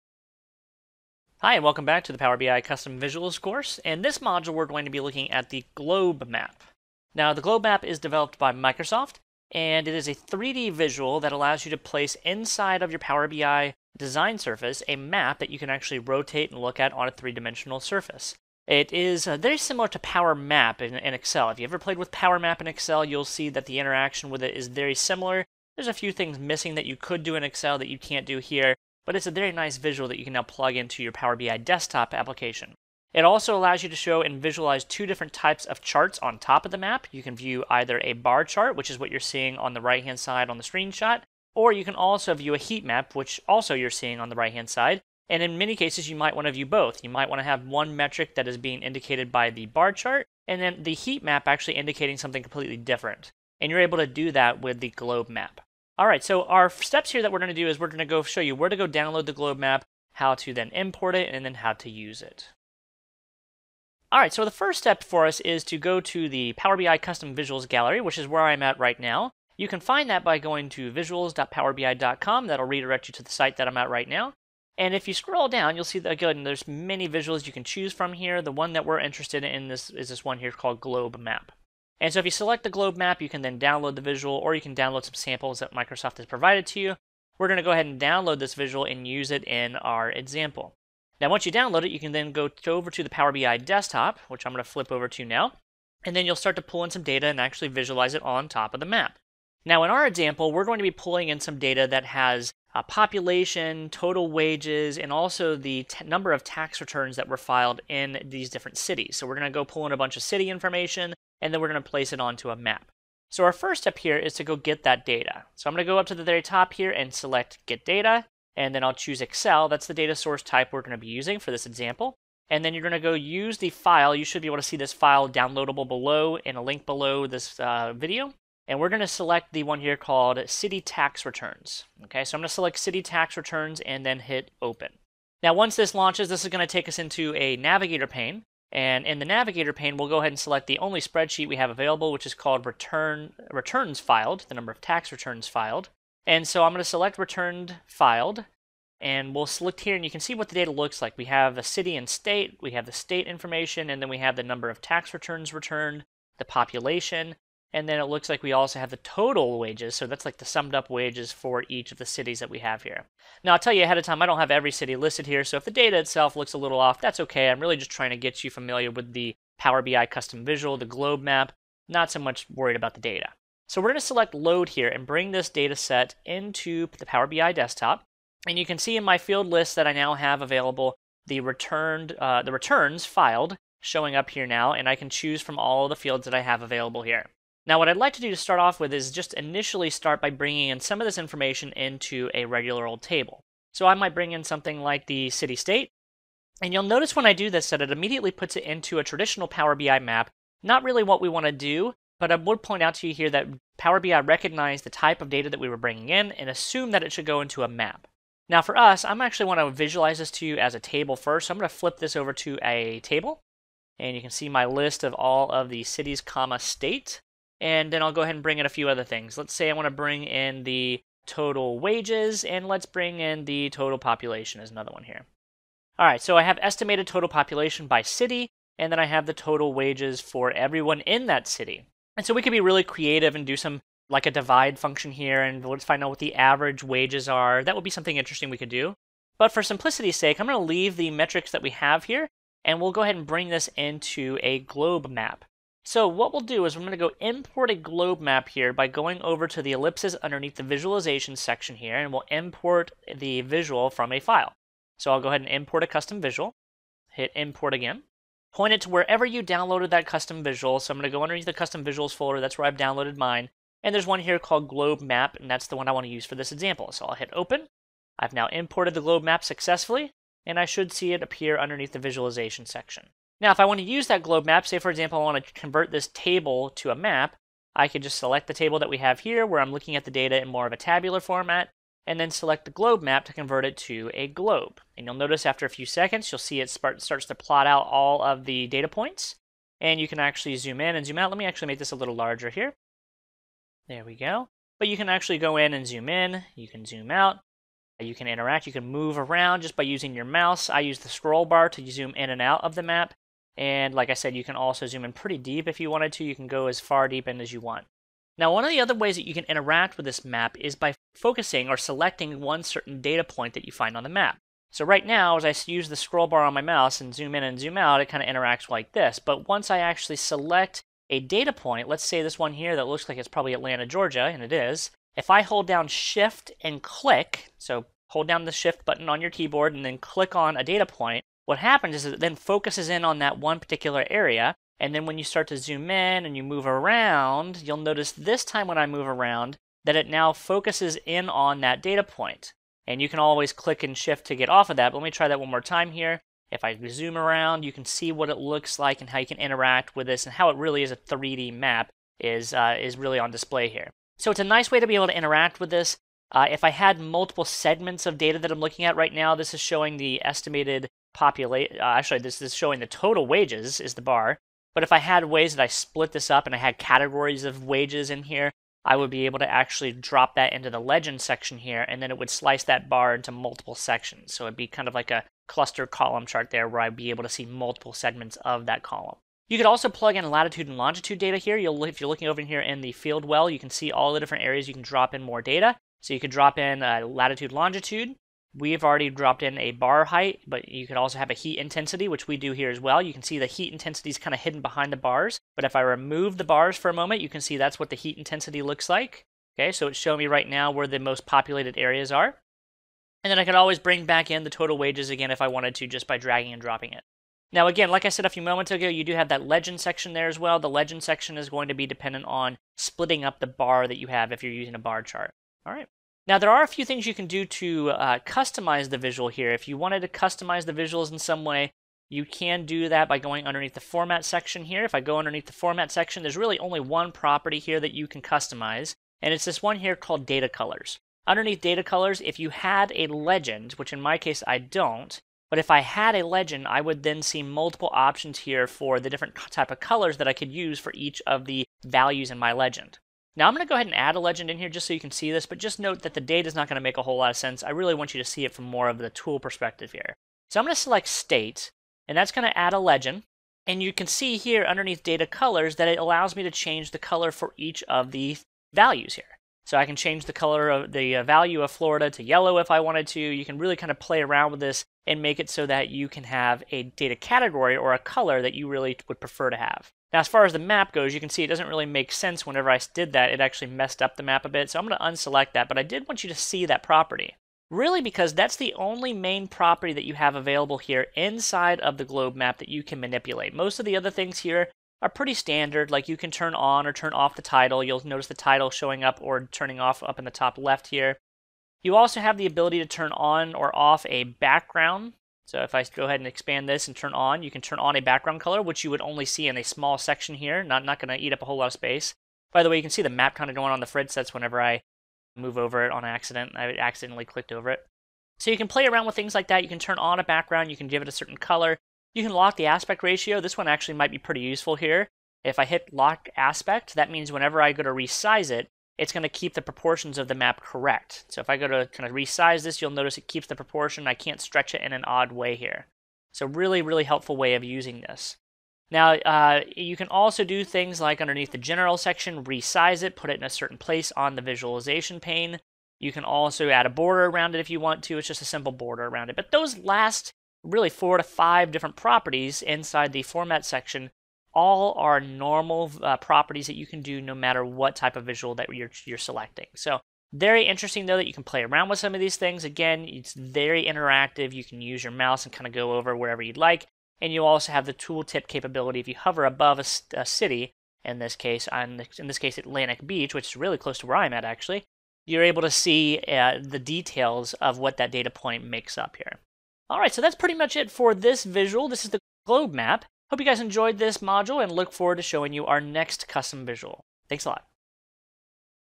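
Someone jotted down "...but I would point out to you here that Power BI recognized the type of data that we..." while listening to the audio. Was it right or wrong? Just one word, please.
right.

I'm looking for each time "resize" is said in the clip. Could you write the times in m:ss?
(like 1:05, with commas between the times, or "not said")
8:37, 8:42, 8:52.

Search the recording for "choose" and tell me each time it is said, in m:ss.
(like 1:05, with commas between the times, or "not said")
1:17, 1:58, 3:05.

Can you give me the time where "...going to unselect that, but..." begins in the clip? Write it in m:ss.
7:54.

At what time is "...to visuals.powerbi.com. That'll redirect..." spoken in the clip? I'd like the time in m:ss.
1:10.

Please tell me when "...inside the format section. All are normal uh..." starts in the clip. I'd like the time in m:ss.
9:02.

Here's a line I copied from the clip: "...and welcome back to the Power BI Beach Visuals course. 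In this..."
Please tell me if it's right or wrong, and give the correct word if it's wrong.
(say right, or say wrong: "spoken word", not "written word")
wrong: "Custom", not "Beach".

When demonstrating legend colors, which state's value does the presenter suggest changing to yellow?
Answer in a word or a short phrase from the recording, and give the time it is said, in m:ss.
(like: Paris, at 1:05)
Florida, at 7:41.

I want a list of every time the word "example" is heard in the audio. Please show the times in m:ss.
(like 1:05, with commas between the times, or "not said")
1:30, 1:40, 2:01, 4:26, 4:34.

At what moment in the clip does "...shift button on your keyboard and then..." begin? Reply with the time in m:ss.
5:28.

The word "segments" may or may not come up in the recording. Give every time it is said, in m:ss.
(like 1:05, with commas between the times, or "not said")
5:57, 6:17.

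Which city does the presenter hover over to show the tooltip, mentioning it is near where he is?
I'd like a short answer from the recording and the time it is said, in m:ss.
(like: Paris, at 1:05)
Atlantic Beach, at 9:22.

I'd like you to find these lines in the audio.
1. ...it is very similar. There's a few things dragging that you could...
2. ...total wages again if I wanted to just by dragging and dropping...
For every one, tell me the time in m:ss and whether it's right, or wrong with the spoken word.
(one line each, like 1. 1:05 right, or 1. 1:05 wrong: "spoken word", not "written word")
1. 0:24 wrong: "missing", not "dragging"
2. 6:44 right.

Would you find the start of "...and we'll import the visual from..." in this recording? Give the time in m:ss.
4:11.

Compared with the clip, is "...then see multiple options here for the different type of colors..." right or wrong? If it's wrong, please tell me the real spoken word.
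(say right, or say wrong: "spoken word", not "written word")
right.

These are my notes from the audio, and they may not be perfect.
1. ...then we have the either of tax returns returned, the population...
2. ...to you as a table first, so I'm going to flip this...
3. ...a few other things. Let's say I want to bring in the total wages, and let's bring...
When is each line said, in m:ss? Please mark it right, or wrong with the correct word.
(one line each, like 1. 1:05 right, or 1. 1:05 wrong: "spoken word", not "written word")
1. 2:34 wrong: "number", not "either"
2. 3:30 right
3. 3:38 right.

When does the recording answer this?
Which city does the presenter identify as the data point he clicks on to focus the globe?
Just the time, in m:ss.
5:23.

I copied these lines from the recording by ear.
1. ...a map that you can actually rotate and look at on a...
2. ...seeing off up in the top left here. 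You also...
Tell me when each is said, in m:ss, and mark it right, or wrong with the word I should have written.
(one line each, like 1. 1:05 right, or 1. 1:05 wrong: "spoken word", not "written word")
1. 0:14 right
2. 8:09 wrong: "turning", not "seeing".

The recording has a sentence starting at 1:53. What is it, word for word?
So our first step here is to go get that data.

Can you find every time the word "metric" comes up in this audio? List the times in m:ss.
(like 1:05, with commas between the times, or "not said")
0:47, 4:01.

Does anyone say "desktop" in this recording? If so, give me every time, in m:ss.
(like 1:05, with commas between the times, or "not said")
0:31, 1:33, 2:57.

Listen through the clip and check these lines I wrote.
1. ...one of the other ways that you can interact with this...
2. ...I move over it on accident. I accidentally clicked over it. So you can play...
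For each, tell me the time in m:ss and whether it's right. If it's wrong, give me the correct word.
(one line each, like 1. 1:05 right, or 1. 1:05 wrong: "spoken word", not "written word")
1. 5:08 right
2. 8:24 right.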